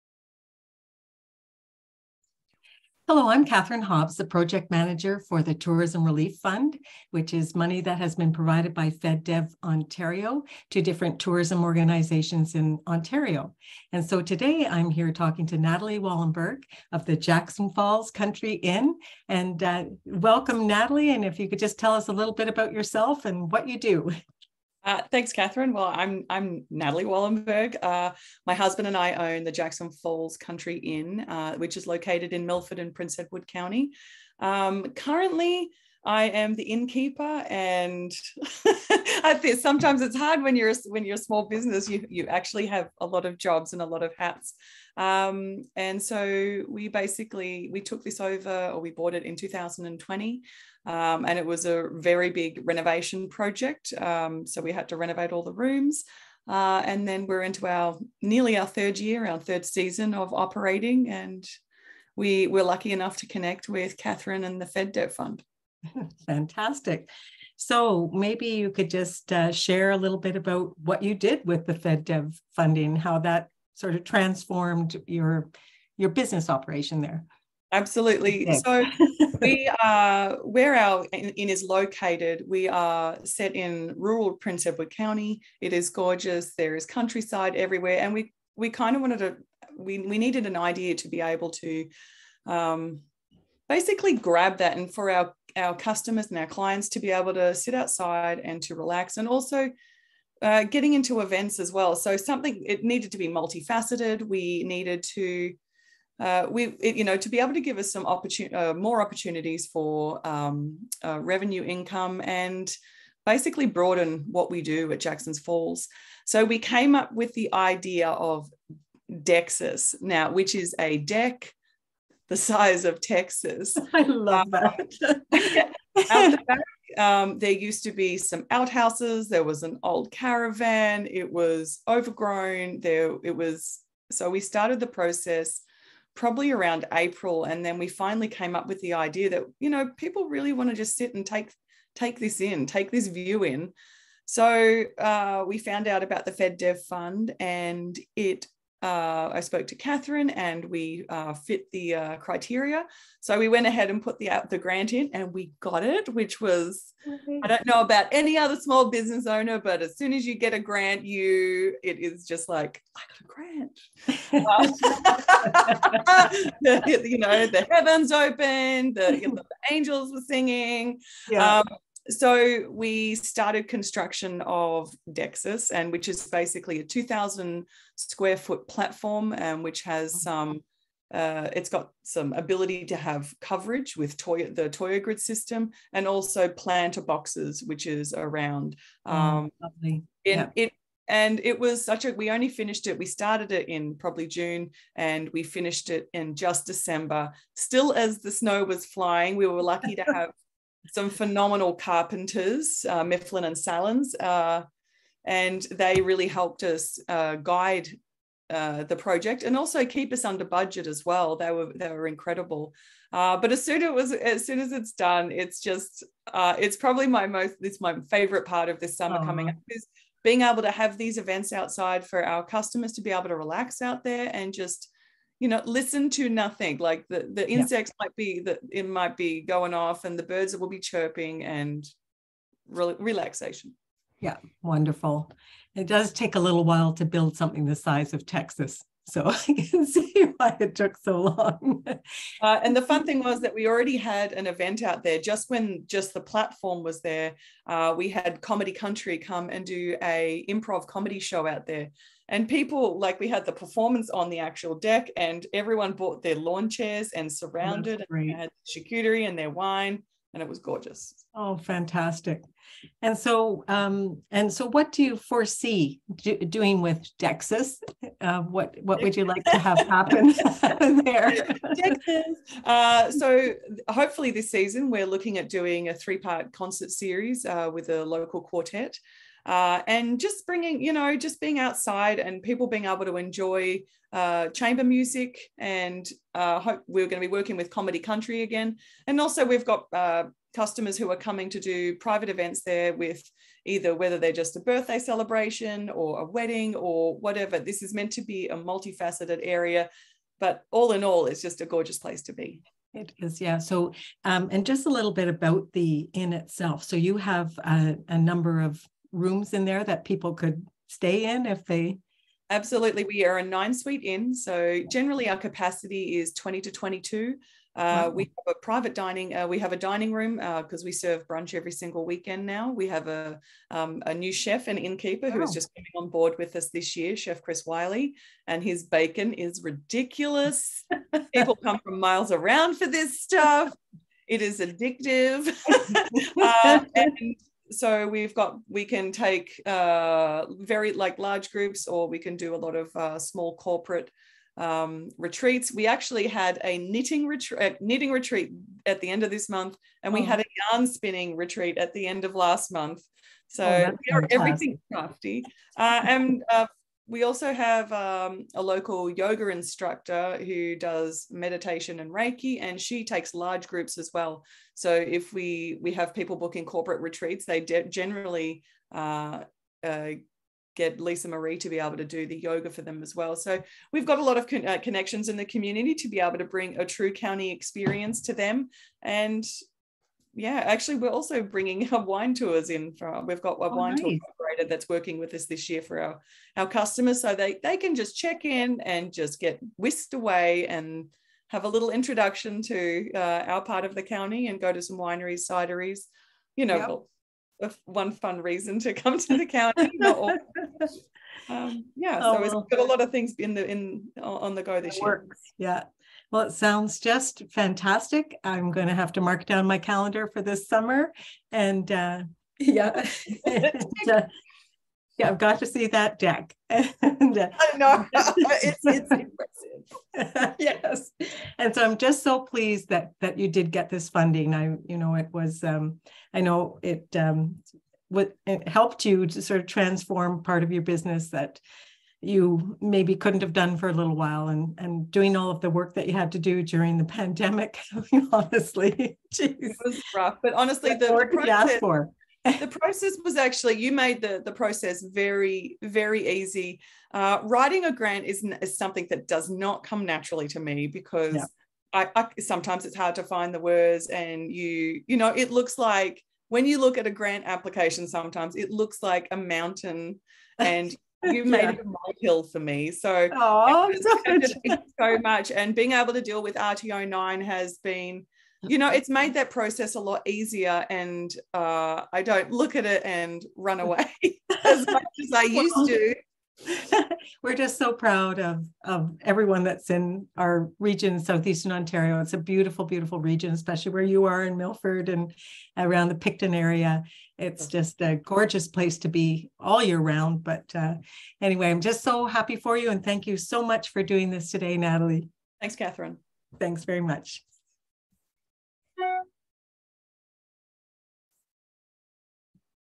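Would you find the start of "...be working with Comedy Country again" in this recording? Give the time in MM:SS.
04:47.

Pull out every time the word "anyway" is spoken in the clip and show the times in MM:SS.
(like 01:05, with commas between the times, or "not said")
08:11.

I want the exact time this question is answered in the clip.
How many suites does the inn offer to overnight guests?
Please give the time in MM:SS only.
05:13.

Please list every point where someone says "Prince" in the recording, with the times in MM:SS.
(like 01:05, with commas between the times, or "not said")
00:32, 01:24.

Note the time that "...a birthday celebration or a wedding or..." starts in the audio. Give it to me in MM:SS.
04:54.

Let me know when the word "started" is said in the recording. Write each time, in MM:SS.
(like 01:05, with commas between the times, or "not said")
02:14, 02:53, 03:13.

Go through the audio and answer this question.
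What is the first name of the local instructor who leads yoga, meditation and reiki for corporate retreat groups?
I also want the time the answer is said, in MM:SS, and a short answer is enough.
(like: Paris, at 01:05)
Lisa Marie, at 06:11.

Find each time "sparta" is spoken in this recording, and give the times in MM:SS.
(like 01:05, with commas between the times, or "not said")
not said.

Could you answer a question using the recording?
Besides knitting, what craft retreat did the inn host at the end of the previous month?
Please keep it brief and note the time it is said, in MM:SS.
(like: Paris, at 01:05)
Yarn spinning retreat, at 05:50.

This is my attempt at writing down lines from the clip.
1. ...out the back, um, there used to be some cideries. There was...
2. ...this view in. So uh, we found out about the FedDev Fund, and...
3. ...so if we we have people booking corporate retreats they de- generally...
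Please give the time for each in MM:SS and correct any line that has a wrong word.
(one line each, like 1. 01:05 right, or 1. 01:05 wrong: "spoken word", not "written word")
1. 02:06 wrong: "outhouses", not "cideries"
2. 02:22 right
3. 06:04 right.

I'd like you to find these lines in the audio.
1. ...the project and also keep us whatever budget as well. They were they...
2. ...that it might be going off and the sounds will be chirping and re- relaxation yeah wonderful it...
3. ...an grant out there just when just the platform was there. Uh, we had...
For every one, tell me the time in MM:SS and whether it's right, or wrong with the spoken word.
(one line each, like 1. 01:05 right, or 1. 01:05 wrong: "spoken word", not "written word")
1. 03:28 wrong: "under", not "whatever"
2. 03:48 wrong: "birds", not "sounds"
3. 04:04 wrong: "event", not "grant".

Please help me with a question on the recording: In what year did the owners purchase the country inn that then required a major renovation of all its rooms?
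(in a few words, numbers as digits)
2020.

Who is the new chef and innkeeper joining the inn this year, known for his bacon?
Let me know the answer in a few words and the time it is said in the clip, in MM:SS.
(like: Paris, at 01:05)
Chris Wiley, at 05:27.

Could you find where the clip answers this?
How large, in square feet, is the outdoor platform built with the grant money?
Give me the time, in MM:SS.
02:56.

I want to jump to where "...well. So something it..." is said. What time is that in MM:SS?
01:41.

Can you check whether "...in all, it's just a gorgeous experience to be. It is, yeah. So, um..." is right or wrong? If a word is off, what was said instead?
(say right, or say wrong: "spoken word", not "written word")
wrong: "place", not "experience".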